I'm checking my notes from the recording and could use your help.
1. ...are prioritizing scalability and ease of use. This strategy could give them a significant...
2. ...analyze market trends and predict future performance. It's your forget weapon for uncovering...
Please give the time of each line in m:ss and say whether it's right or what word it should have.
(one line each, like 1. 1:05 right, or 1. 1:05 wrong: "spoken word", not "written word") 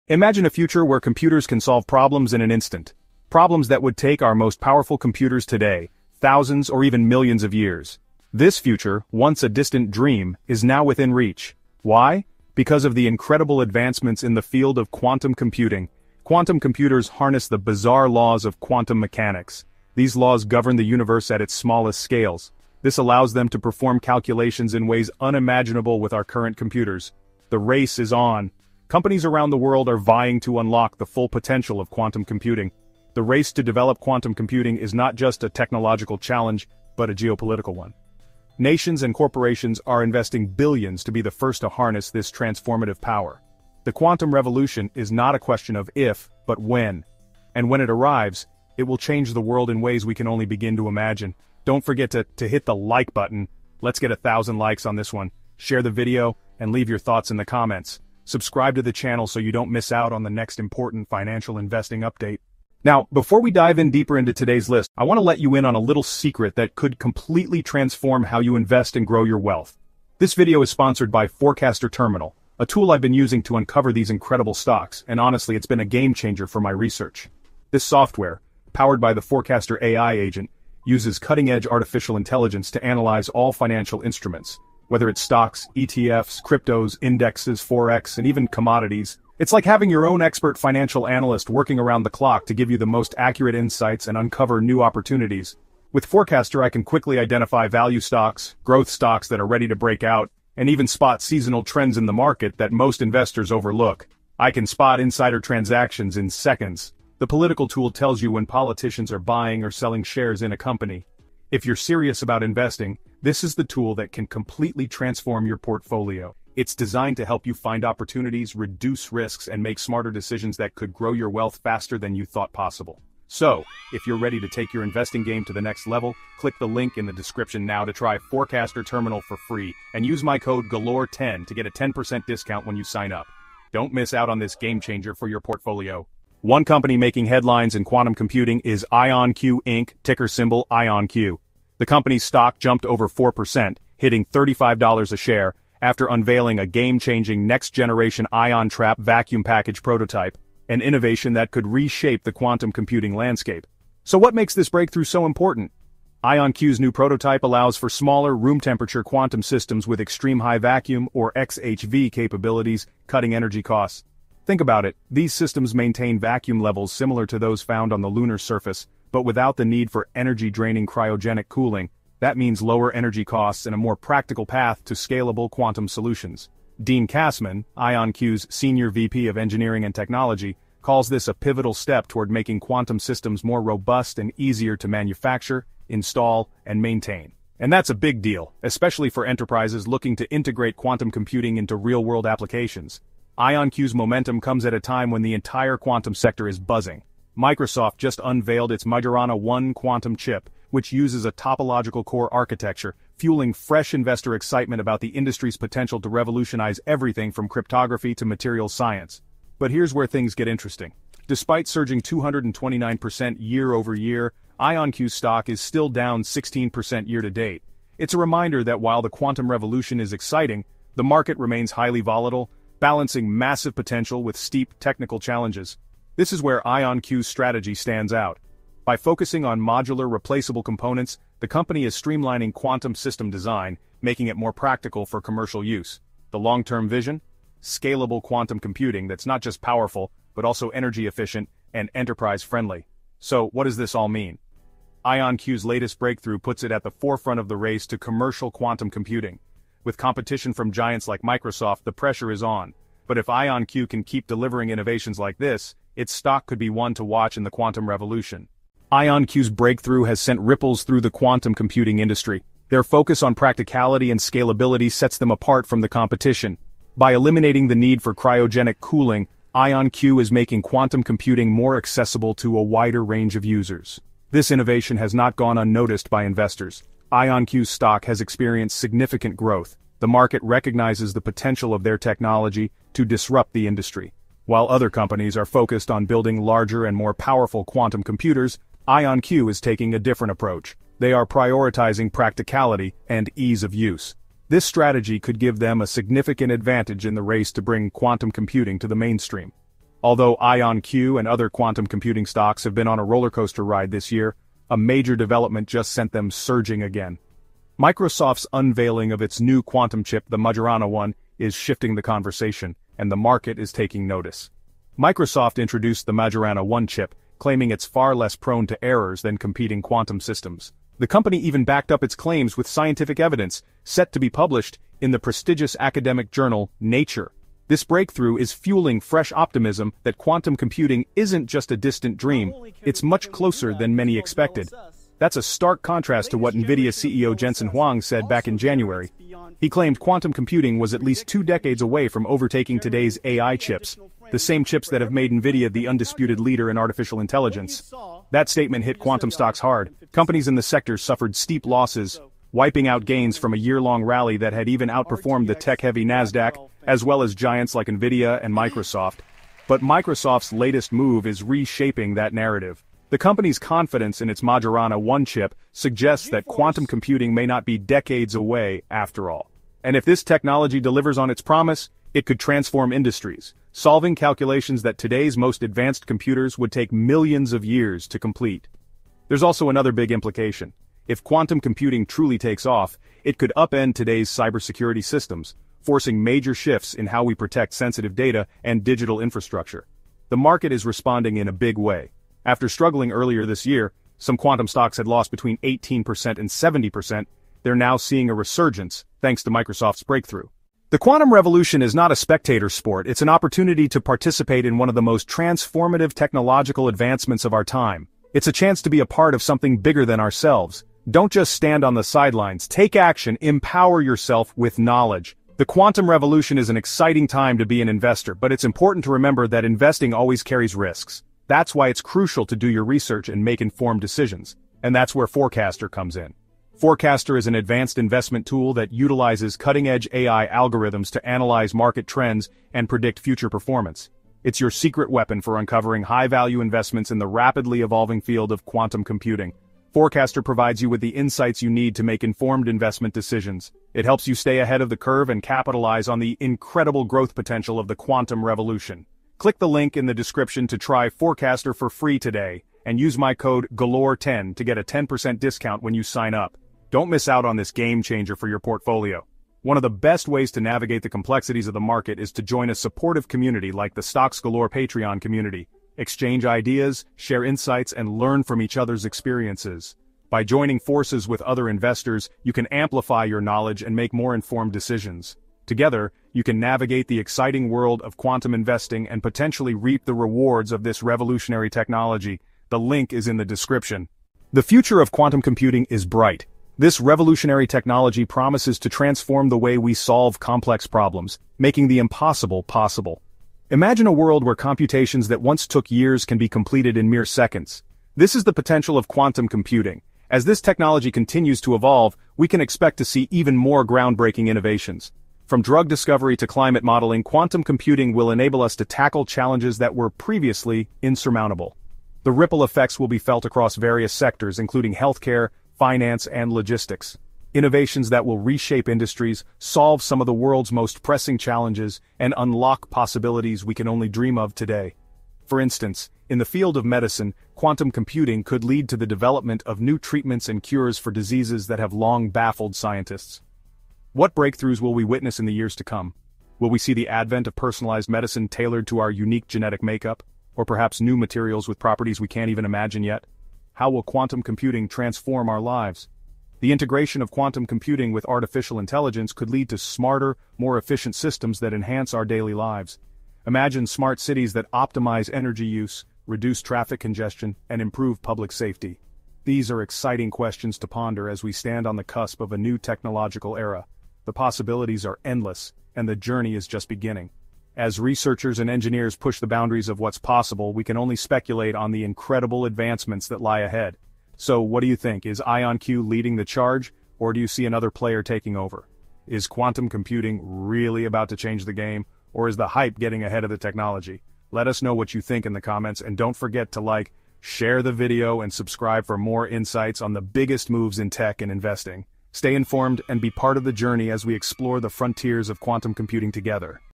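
1. 4:51 wrong: "practicality", not "scalability"
2. 7:11 wrong: "secret", not "forget".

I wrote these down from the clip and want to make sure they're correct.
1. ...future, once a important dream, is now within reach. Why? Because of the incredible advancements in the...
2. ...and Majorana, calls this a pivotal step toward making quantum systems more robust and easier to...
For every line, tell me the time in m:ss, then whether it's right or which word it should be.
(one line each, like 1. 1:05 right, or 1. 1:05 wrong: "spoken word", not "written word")
1. 0:08 wrong: "distant", not "important"
2. 2:59 wrong: "Technology", not "Majorana".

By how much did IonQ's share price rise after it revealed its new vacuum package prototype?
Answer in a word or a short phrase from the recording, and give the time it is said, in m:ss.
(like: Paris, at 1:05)
over 4%, at 2:22.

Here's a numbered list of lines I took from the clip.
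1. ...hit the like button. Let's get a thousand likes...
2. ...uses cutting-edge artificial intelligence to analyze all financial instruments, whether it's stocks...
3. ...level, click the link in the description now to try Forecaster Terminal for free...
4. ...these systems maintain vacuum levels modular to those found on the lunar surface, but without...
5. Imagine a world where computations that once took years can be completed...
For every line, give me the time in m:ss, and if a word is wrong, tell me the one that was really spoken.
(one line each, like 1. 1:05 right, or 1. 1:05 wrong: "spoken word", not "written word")
1. 0:52 right
2. 1:20 right
3. 2:05 right
4. 2:45 wrong: "similar", not "modular"
5. 8:13 right.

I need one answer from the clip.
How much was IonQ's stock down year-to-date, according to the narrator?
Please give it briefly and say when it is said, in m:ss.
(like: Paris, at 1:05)
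16%, at 3:36.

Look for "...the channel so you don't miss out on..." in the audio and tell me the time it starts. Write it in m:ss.
0:58.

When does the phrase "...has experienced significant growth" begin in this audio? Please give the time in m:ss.
4:38.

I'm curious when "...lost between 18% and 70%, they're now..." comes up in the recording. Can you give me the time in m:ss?
6:35.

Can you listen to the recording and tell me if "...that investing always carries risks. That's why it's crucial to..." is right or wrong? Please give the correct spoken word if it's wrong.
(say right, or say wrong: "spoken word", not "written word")
right.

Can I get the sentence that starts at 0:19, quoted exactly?
These laws govern the universe at its smallest scales.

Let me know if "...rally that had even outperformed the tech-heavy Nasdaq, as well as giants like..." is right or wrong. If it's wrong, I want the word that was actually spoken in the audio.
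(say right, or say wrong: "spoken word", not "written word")
right.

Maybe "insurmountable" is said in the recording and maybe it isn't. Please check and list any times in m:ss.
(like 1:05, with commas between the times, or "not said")
8:31.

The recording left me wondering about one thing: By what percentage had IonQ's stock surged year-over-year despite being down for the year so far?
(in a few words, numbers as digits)
229%.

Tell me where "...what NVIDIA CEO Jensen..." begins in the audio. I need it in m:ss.
5:36.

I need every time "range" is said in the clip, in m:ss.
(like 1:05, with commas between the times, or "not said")
4:33.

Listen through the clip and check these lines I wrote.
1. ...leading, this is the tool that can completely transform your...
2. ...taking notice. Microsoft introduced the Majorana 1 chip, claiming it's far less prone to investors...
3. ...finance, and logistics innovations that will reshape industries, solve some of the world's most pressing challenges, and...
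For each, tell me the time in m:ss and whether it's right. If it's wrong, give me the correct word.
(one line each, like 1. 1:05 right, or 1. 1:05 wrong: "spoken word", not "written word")
1. 1:52 wrong: "investing", not "leading"
2. 5:13 wrong: "errors", not "investors"
3. 8:35 right.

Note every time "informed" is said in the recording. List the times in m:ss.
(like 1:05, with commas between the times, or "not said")
7:03, 7:22, 7:54, 9:52.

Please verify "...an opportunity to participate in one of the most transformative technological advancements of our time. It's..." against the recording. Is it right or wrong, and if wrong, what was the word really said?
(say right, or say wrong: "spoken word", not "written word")
right.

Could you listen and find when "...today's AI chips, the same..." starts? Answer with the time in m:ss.
5:42.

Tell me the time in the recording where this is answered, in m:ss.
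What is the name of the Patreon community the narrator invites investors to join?
7:44.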